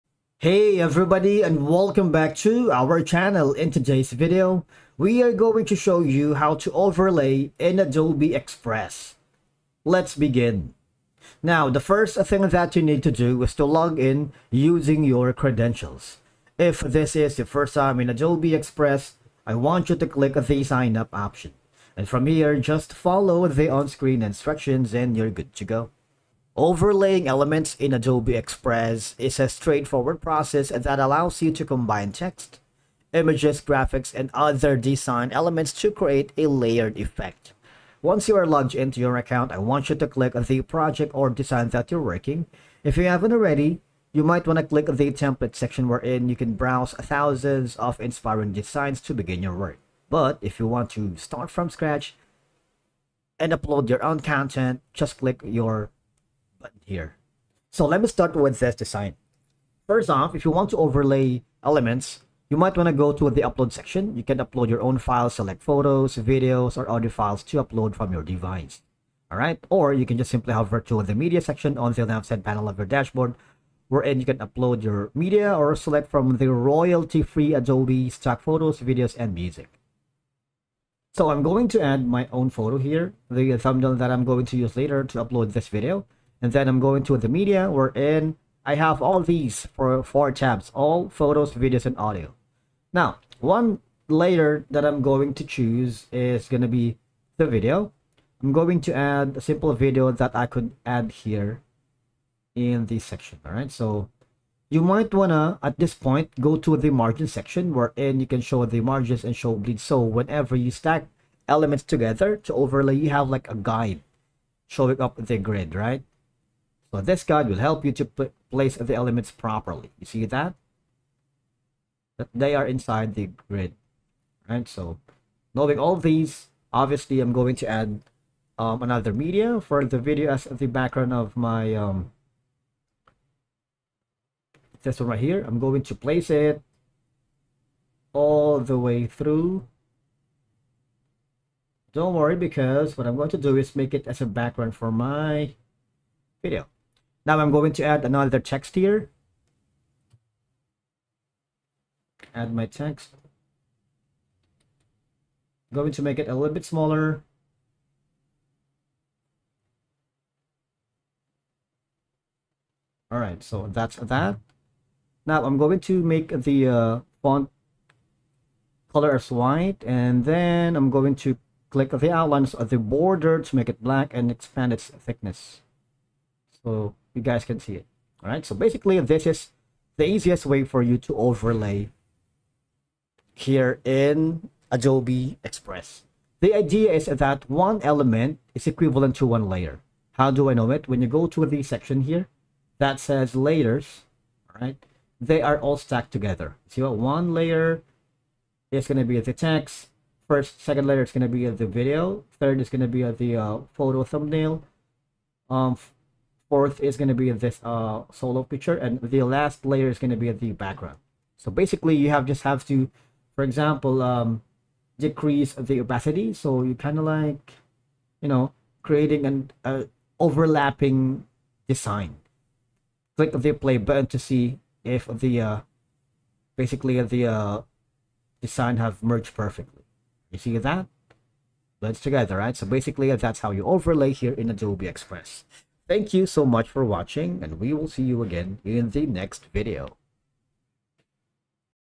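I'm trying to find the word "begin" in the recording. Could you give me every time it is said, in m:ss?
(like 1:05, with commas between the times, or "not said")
0:10, 0:49.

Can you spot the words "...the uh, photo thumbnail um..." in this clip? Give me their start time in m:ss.
3:23.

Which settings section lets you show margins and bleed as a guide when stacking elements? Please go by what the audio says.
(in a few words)
Margin section.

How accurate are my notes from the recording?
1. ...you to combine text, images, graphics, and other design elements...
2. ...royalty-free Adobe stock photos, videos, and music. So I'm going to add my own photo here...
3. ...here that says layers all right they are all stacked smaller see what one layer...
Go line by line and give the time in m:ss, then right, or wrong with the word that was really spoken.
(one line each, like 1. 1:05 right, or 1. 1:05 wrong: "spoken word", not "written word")
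1. 0:31 right
2. 1:16 right
3. 3:12 wrong: "together", not "smaller".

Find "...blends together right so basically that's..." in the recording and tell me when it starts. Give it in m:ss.
3:51.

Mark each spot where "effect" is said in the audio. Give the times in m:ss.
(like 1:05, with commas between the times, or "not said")
0:36.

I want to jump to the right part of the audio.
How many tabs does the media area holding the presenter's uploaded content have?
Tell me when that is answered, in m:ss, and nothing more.
1:30.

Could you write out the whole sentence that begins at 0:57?
So let me start with this design.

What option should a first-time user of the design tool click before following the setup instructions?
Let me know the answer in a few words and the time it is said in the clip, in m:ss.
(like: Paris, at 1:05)
Sign up, at 0:20.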